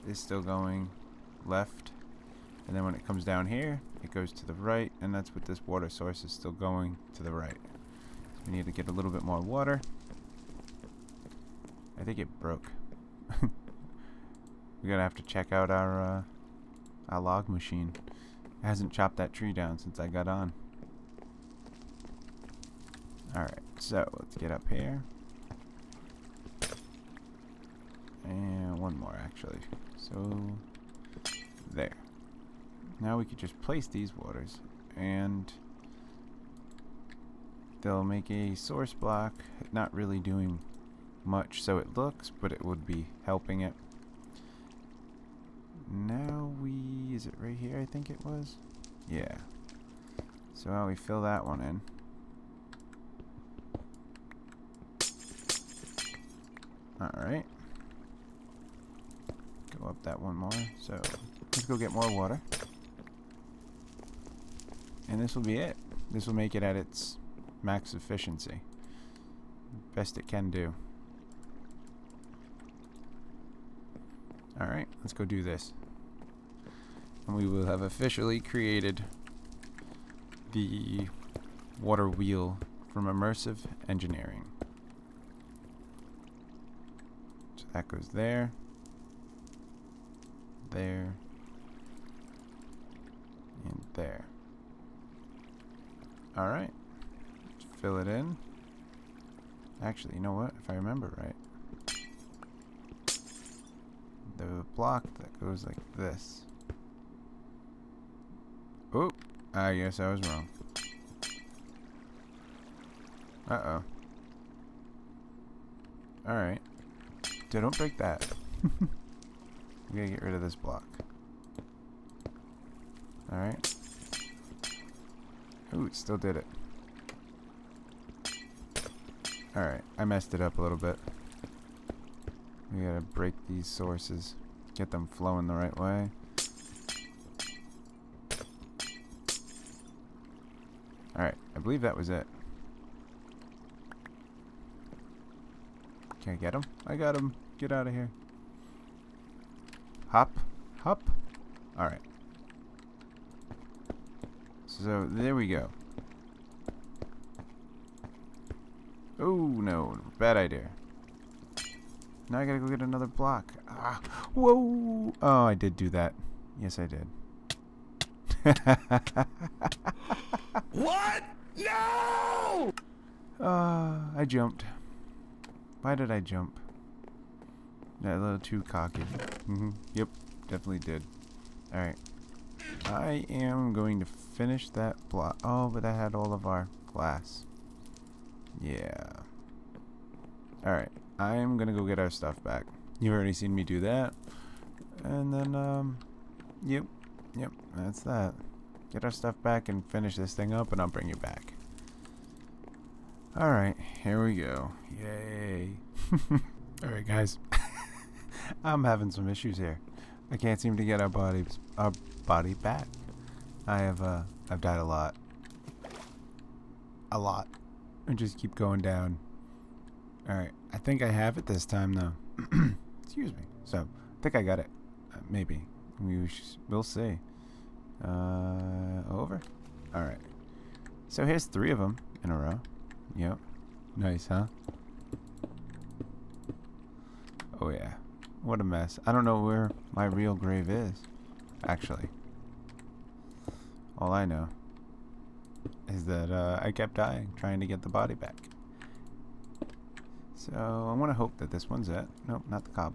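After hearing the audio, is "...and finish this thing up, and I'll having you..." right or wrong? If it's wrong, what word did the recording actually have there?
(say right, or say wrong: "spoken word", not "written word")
wrong: "bring", not "having".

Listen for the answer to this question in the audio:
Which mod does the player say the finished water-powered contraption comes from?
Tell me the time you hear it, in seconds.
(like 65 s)
83 s.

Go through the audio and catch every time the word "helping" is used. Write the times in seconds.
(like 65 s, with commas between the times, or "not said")
43 s.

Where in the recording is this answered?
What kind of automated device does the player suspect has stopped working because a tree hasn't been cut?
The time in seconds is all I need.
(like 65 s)
17 s.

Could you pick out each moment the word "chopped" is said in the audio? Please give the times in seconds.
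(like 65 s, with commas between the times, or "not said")
18 s.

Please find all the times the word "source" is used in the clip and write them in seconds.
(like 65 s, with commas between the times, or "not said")
5 s, 38 s, 133 s.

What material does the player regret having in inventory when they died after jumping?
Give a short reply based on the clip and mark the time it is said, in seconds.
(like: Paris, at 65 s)
glass, at 186 s.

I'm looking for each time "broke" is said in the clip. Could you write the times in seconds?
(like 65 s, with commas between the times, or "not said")
12 s.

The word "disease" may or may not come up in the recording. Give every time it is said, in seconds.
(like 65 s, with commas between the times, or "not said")
not said.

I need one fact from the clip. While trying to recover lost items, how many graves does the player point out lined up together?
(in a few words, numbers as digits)
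3.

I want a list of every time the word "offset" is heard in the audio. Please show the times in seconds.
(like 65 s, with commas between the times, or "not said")
not said.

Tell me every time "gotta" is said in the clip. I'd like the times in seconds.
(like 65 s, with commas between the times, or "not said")
119 s, 132 s, 162 s.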